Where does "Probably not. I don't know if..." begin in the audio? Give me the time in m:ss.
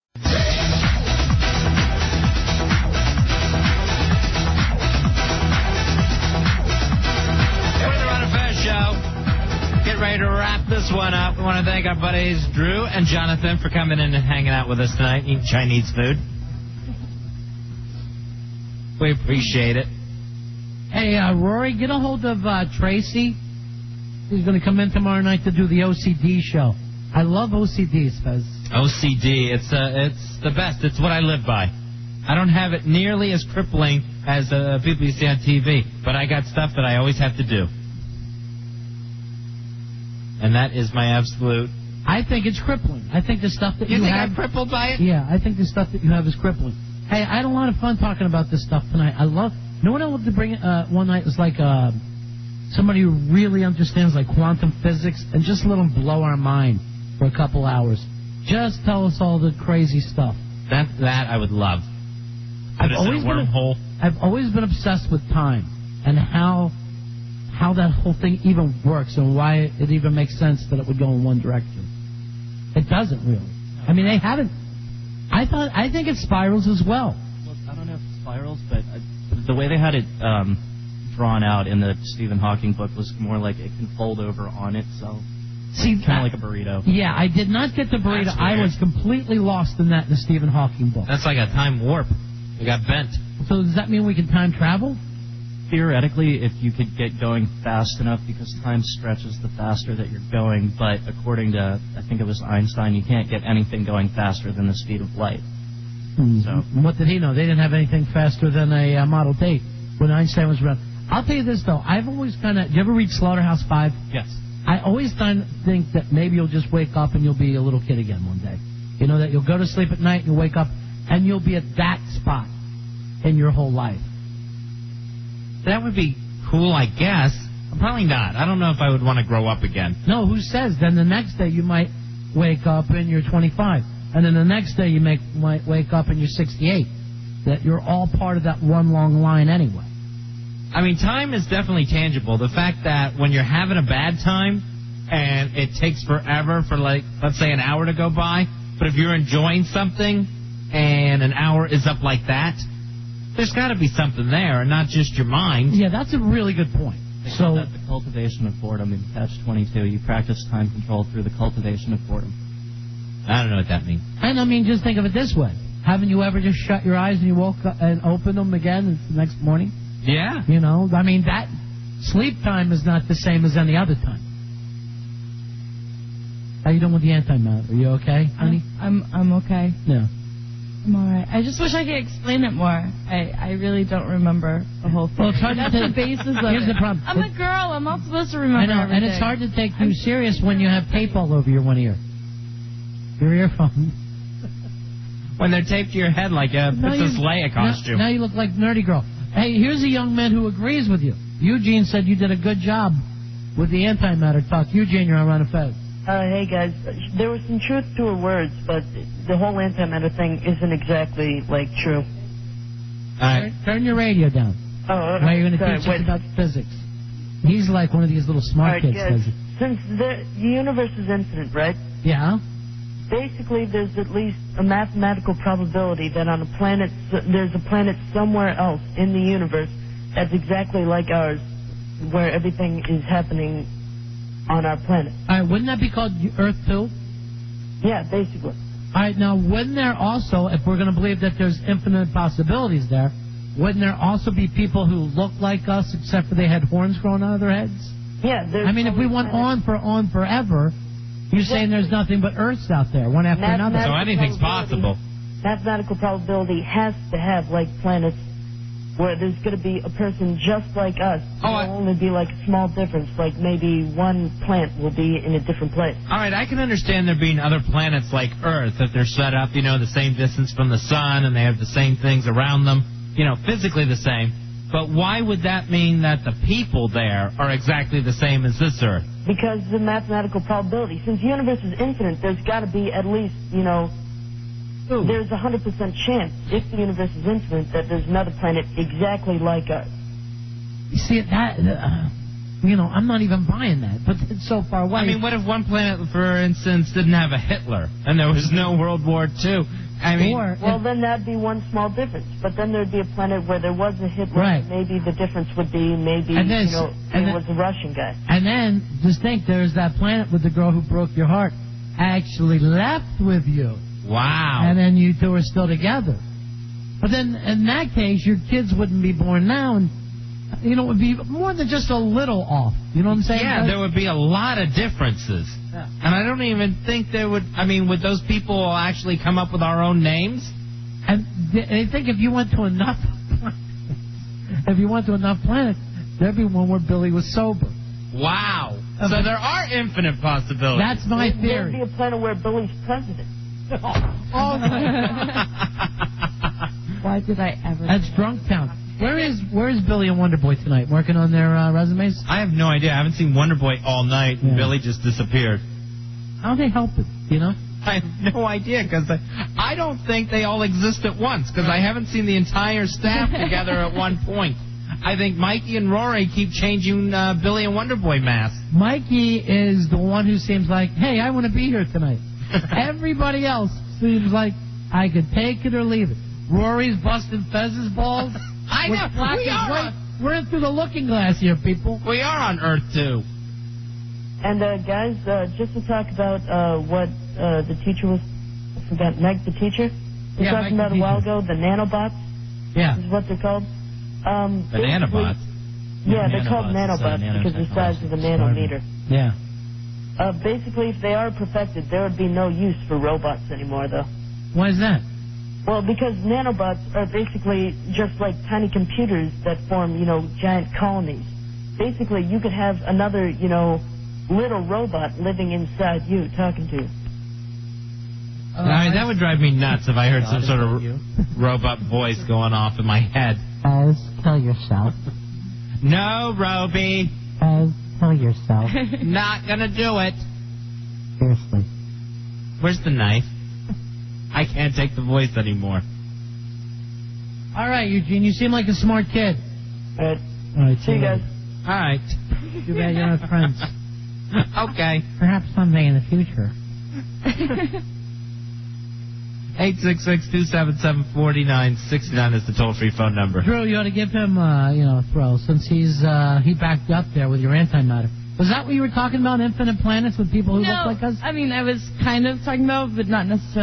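2:07.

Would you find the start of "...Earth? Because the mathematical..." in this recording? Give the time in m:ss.
4:38.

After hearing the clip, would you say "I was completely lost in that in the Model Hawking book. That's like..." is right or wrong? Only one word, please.
wrong.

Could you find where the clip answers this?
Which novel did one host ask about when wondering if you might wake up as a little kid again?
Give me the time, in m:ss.
1:53.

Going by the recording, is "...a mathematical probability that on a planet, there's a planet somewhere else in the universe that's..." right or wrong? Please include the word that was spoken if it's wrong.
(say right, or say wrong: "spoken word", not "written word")
right.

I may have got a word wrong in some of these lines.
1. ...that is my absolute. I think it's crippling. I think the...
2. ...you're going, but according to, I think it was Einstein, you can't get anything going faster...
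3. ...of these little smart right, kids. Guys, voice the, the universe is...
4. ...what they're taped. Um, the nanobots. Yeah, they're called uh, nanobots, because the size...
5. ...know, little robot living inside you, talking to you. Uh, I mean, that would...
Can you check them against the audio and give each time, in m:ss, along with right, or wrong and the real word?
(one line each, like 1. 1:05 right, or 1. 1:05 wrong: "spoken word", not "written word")
1. 0:40 right
2. 1:40 right
3. 3:38 wrong: "since", not "voice"
4. 6:33 wrong: "called", not "taped"
5. 6:53 right.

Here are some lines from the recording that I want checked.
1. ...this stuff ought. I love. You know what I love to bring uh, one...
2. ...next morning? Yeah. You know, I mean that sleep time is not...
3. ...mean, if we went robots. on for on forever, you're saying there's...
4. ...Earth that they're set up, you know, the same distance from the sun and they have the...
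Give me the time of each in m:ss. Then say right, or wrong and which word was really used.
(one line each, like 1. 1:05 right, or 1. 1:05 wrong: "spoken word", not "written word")
1. 0:48 wrong: "tonight", not "ought"
2. 2:49 right
3. 4:08 wrong: "planets", not "robots"
4. 4:28 right.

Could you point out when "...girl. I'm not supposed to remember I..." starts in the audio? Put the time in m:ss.
3:07.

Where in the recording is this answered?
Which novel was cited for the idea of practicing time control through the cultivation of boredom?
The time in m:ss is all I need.
2:39.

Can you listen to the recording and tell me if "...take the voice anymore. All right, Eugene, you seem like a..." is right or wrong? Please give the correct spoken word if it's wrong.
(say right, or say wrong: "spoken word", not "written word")
right.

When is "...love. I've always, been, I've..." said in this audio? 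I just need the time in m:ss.
1:01.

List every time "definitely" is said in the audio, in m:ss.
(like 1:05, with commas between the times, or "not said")
2:21.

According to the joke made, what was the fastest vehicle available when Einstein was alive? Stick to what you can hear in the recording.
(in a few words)
Model T.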